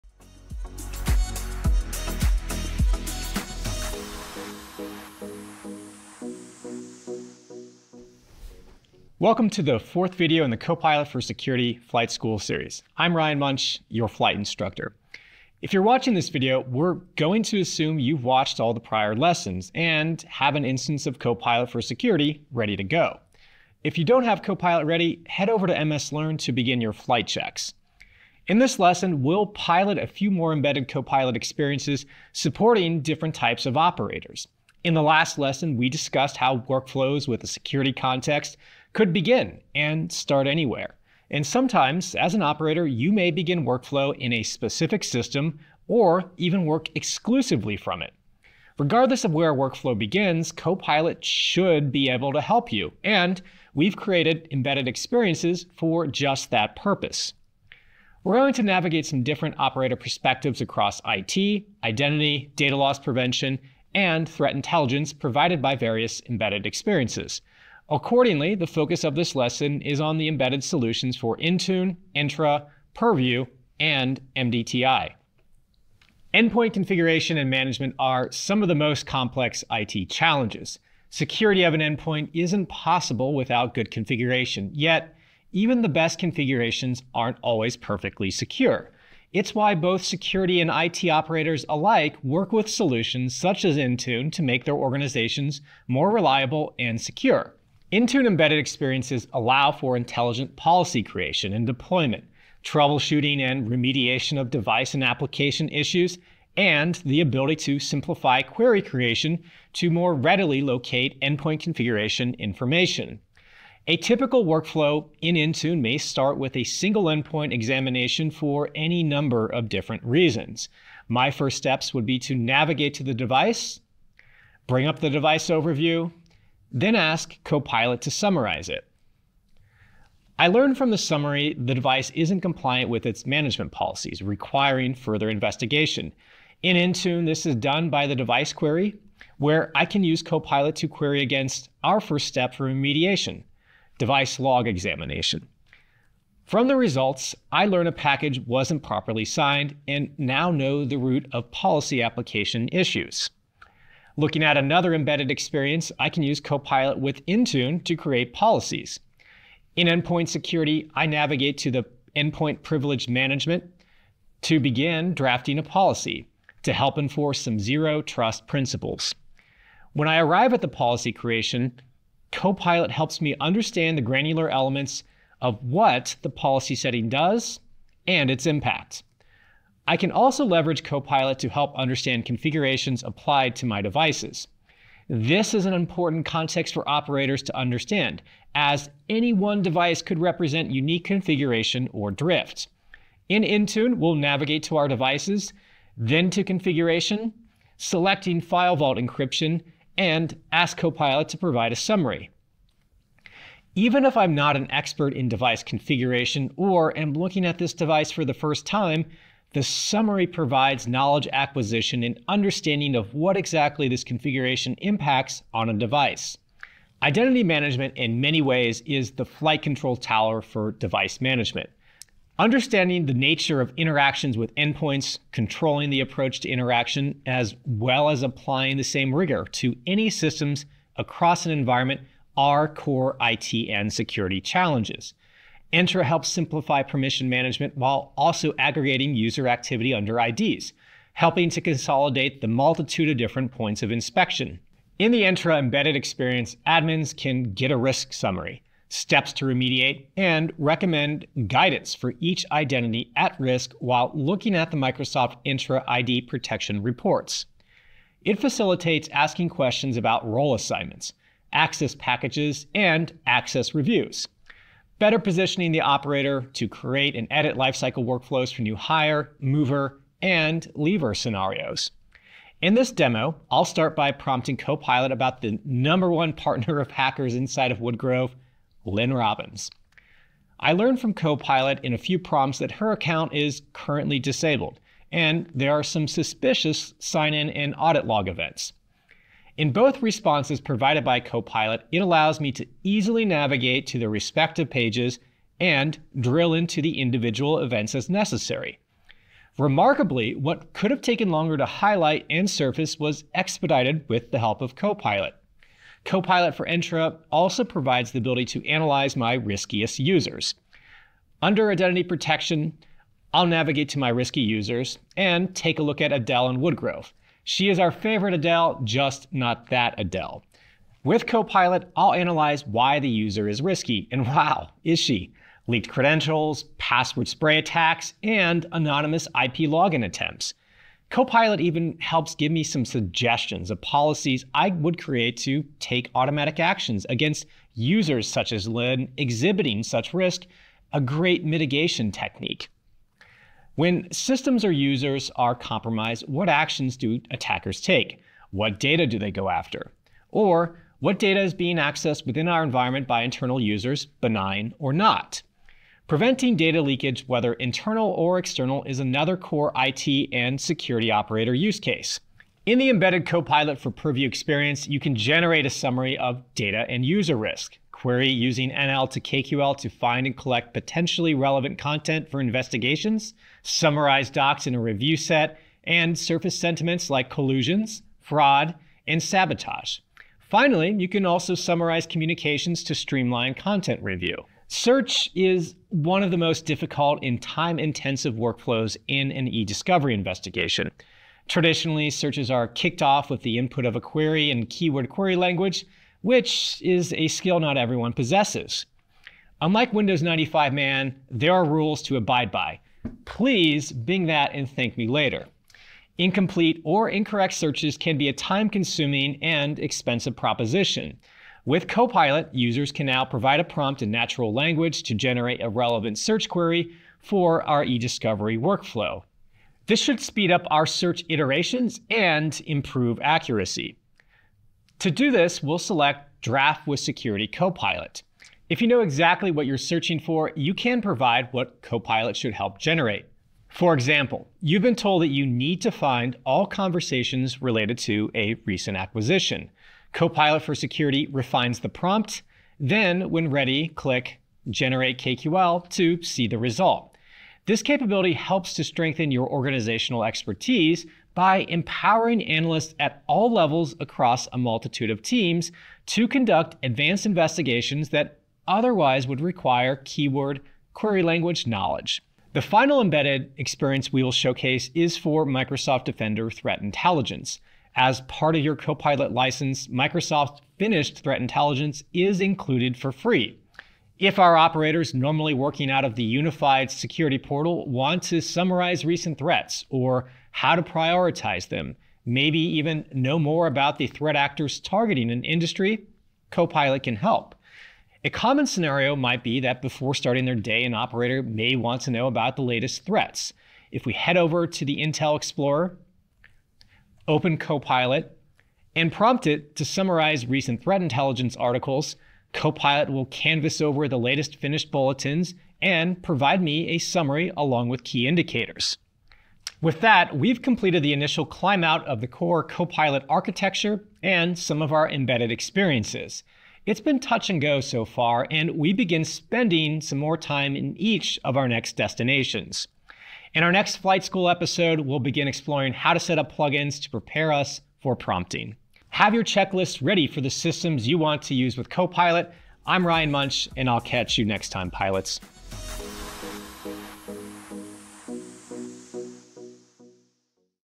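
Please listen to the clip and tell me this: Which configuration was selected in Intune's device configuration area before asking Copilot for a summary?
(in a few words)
File Vault encryption.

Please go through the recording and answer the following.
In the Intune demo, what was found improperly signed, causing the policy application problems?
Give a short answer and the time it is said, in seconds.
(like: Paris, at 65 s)
A package, at 147 s.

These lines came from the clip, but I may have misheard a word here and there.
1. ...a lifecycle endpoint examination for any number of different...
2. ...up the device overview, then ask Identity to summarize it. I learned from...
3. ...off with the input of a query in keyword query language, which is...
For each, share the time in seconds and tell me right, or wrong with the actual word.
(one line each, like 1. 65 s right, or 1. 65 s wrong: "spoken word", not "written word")
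1. 116 s wrong: "single", not "lifecycle"
2. 124 s wrong: "Copilot", not "Identity"
3. 393 s right.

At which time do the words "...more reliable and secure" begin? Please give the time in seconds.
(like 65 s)
95 s.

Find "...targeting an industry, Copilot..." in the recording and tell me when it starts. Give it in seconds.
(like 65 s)
484 s.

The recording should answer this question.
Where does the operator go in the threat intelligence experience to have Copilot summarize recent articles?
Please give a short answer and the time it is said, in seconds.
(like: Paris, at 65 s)
Intel Explorer, at 495 s.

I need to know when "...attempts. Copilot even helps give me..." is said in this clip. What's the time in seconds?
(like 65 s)
330 s.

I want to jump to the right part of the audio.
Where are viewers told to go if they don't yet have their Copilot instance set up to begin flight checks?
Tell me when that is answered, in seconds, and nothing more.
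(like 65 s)
25 s.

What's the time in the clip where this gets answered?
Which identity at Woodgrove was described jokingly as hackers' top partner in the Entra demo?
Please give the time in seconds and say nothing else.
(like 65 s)
278 s.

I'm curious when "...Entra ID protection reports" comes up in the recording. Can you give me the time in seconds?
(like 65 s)
255 s.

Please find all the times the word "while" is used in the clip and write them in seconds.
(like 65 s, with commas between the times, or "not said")
237 s, 253 s.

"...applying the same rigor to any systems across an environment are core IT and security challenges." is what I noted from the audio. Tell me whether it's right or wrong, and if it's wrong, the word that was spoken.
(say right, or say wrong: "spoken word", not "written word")
right.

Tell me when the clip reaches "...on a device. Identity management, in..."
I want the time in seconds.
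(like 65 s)
215 s.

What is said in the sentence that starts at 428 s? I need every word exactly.
If you know exactly what you're searching for, you can provide what Copilot should help generate.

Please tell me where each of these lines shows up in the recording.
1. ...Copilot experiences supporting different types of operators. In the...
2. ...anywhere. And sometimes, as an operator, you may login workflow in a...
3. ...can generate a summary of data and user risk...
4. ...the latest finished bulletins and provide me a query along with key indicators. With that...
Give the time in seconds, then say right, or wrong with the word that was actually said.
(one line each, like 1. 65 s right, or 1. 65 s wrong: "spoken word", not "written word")
1. 30 s right
2. 40 s wrong: "begin", not "login"
3. 364 s right
4. 504 s wrong: "summary", not "query".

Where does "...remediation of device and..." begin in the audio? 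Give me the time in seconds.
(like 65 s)
103 s.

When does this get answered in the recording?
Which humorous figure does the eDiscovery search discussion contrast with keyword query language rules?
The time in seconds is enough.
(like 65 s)
399 s.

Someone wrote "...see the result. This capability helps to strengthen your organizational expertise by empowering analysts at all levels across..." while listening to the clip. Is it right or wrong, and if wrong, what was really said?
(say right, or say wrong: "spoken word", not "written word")
right.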